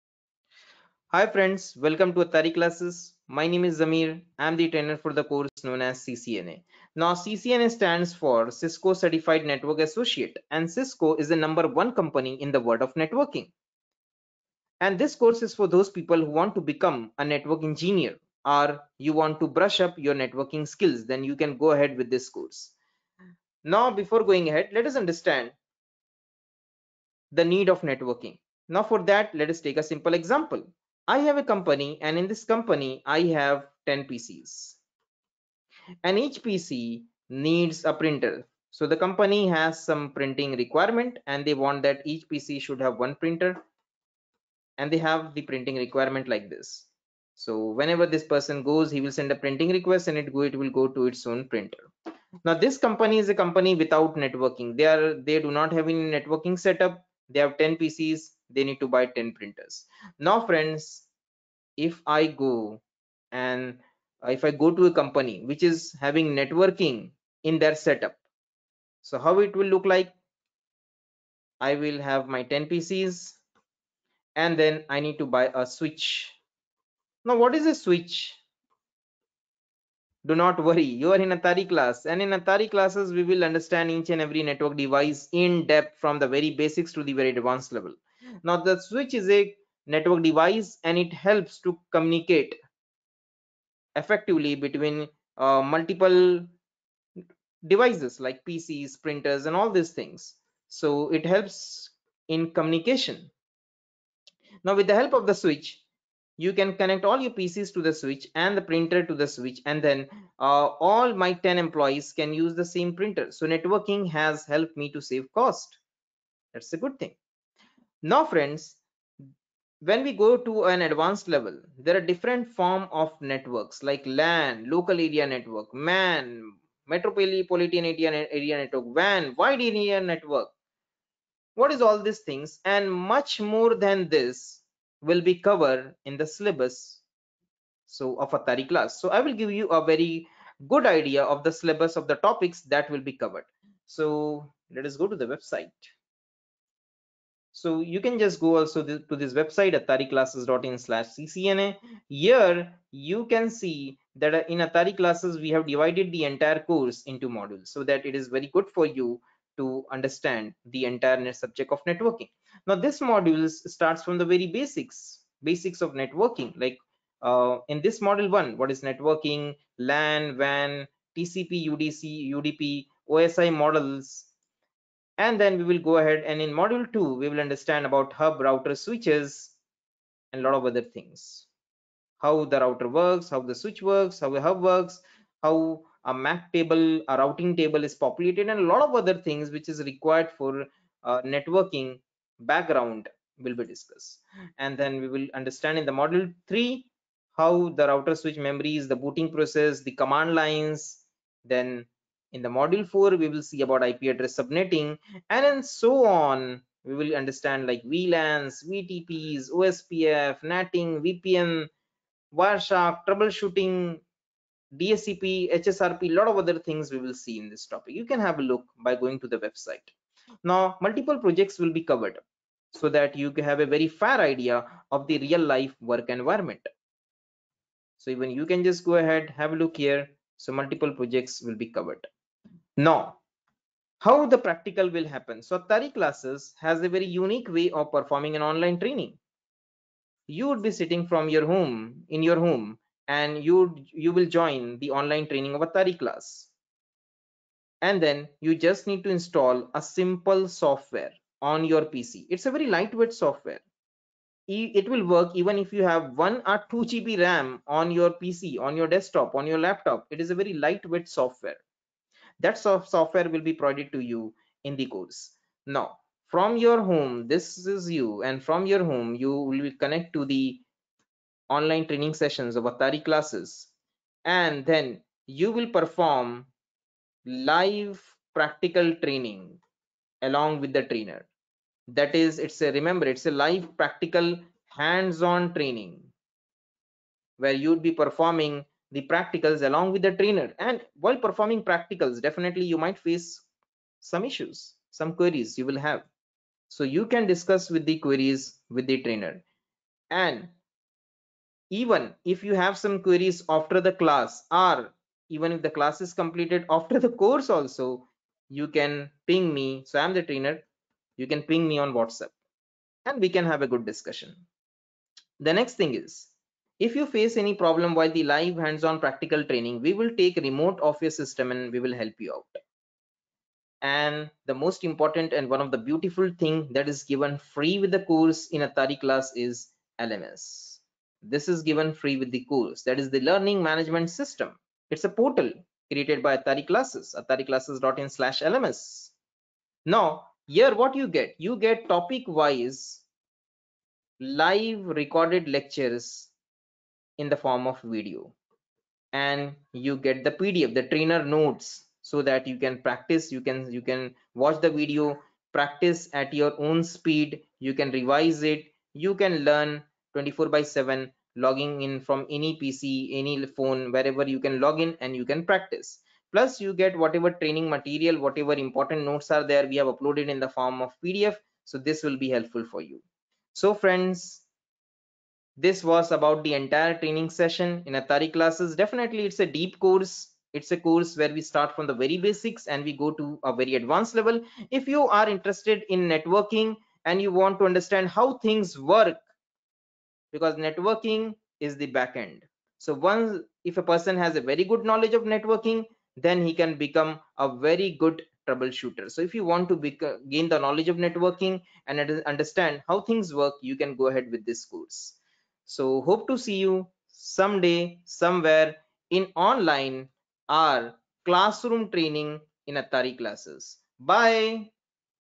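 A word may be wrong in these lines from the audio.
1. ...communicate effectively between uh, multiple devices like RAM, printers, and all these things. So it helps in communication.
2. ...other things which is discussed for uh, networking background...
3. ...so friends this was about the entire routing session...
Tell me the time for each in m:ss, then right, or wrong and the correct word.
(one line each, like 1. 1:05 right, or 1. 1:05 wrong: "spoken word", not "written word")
1. 1:31 wrong: "PCs", not "RAM"
2. 3:09 wrong: "required", not "discussed"
3. 6:13 wrong: "training", not "routing".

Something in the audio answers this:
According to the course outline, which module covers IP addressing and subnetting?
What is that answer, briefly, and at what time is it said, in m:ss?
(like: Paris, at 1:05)
Module 4, at 3:22.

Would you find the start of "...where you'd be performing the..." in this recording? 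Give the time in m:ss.
4:47.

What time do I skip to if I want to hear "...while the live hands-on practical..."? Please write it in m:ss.
5:17.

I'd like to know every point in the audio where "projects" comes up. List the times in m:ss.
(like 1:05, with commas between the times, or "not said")
3:41, 3:50.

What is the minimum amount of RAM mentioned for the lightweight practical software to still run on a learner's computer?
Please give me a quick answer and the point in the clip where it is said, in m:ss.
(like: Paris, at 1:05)
1 GB, at 4:16.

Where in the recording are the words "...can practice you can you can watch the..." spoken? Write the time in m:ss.
5:52.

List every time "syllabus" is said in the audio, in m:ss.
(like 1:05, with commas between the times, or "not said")
2:16, 2:21.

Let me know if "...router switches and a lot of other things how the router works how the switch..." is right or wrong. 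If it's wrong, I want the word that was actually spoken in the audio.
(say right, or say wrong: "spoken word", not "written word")
right.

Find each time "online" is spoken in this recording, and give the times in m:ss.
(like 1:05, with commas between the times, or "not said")
3:58, 4:04, 4:31, 6:49.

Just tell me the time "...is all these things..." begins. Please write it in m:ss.
2:11.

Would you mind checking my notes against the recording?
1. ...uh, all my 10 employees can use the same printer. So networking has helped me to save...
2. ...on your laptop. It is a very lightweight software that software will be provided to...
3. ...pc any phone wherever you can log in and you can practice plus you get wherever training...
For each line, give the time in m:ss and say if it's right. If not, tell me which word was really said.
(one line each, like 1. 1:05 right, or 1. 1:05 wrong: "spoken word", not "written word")
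1. 1:50 right
2. 4:19 right
3. 6:02 wrong: "whatever", not "wherever".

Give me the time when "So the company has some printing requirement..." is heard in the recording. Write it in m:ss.
0:38.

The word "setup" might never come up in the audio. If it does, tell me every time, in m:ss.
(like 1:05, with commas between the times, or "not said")
0:56, 1:07.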